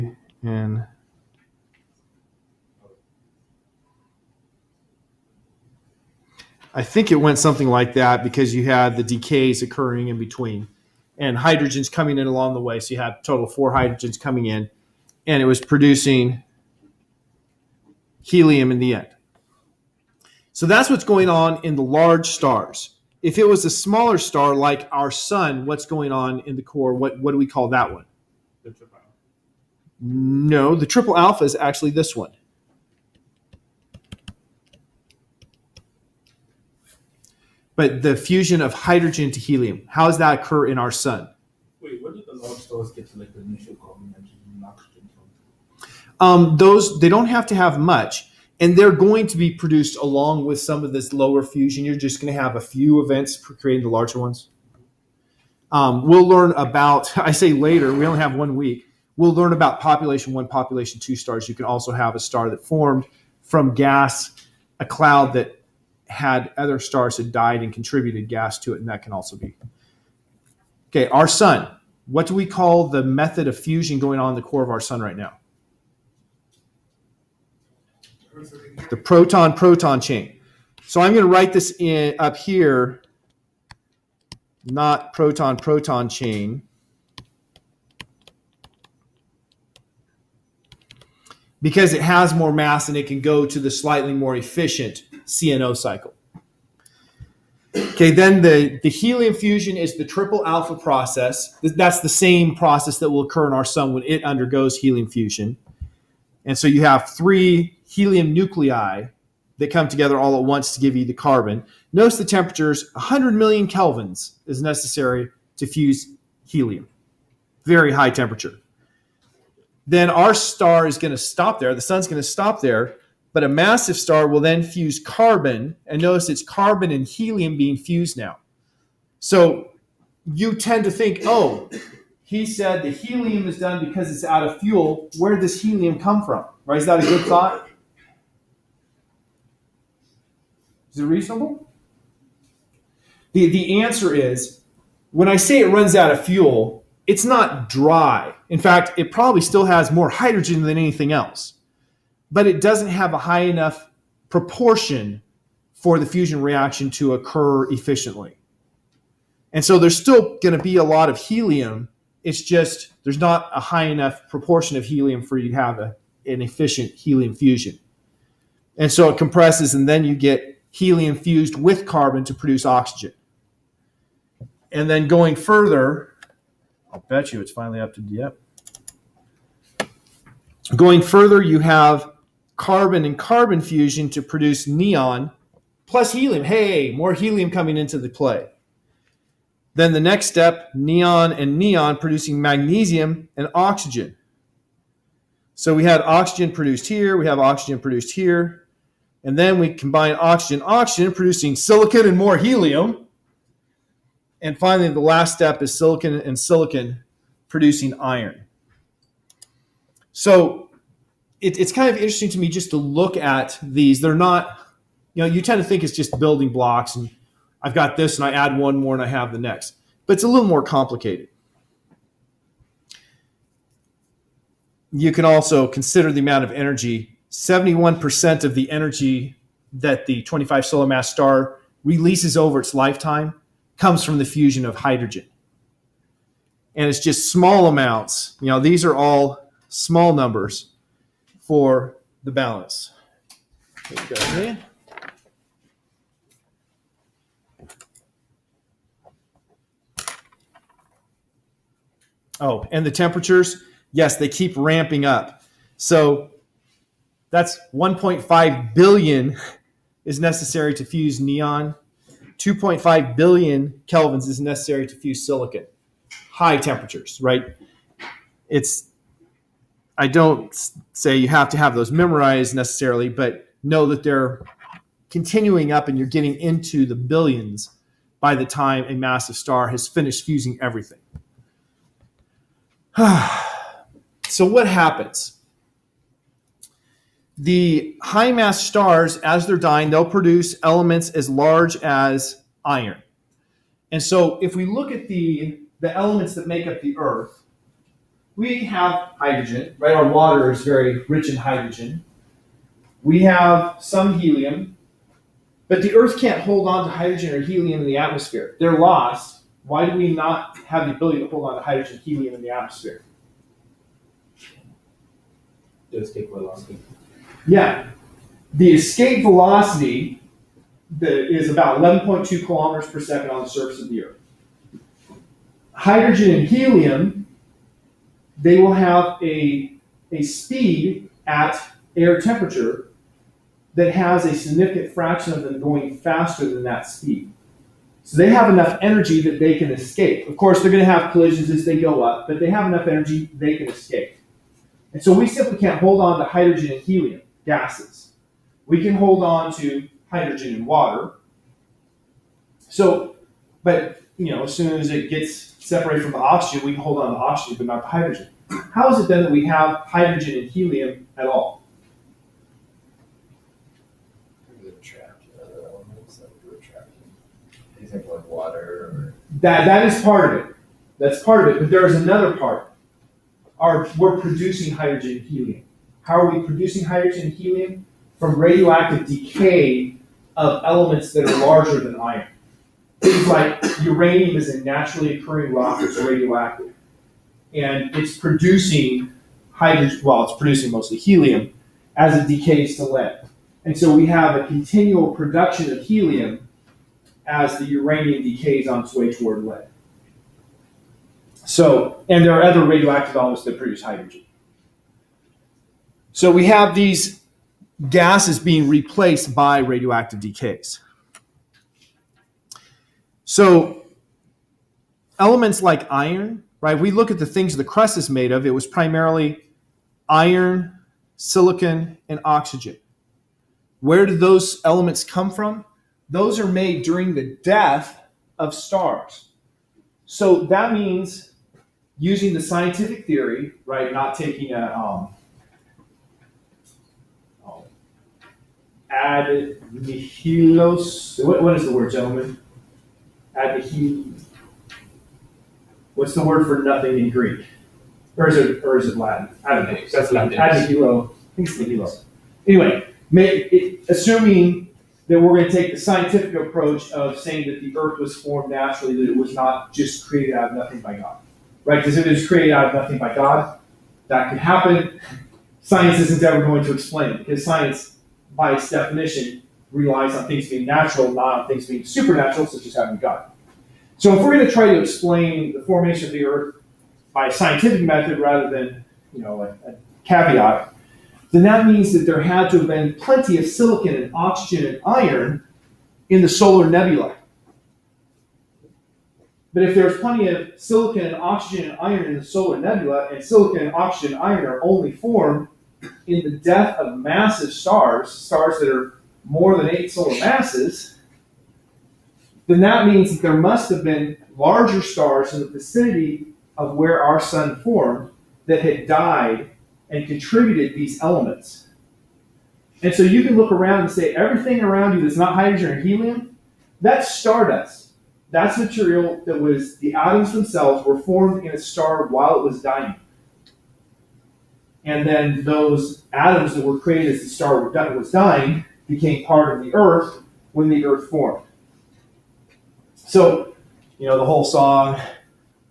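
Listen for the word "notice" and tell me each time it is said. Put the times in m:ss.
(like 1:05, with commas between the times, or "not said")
1:51, 2:06.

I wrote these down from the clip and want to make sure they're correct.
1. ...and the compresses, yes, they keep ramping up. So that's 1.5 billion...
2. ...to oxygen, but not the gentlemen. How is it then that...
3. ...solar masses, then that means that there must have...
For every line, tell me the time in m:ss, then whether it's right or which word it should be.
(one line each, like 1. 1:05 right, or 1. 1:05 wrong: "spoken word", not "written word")
1. 4:12 wrong: "temperatures", not "compresses"
2. 5:57 wrong: "hydrogen", not "gentlemen"
3. 8:19 right.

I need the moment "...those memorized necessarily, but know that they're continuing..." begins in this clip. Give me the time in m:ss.
4:31.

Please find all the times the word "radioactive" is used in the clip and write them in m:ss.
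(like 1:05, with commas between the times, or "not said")
6:18, 6:25, 6:42, 6:49.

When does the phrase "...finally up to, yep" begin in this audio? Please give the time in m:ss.
2:57.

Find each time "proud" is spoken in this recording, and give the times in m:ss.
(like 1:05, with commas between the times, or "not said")
not said.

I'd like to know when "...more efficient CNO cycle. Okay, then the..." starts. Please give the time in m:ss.
1:34.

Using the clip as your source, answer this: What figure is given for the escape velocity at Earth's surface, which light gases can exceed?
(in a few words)
11.2 kilometers per second.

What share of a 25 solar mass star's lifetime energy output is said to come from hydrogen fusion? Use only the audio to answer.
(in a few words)
71%.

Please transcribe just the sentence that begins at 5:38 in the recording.
So they have enough energy that they can escape.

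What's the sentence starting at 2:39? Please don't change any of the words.
And so there's still going to be a lot of helium.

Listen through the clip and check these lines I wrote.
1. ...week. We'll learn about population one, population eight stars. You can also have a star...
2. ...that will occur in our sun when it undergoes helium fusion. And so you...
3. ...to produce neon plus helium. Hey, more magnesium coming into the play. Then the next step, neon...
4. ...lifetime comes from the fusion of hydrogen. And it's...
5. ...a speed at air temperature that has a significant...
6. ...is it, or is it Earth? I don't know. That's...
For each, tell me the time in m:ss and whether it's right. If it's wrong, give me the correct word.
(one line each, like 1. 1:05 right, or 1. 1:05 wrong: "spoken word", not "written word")
1. 0:58 wrong: "two", not "eight"
2. 1:42 right
3. 3:04 wrong: "helium", not "magnesium"
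4. 3:52 right
5. 5:30 right
6. 7:28 wrong: "Latin", not "Earth".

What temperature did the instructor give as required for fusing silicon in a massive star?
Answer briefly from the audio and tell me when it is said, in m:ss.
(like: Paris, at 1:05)
2.5 billion kelvins, at 4:22.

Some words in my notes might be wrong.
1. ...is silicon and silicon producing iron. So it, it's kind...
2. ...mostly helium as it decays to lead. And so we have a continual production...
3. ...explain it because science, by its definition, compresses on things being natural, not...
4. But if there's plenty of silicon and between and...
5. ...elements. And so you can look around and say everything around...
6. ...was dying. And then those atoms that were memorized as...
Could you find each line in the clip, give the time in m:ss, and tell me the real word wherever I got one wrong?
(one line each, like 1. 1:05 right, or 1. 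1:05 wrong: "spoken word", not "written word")
1. 3:25 right
2. 6:30 right
3. 7:46 wrong: "relies", not "compresses"
4. 8:09 wrong: "oxygen", not "between"
5. 8:31 right
6. 8:42 wrong: "created", not "memorized".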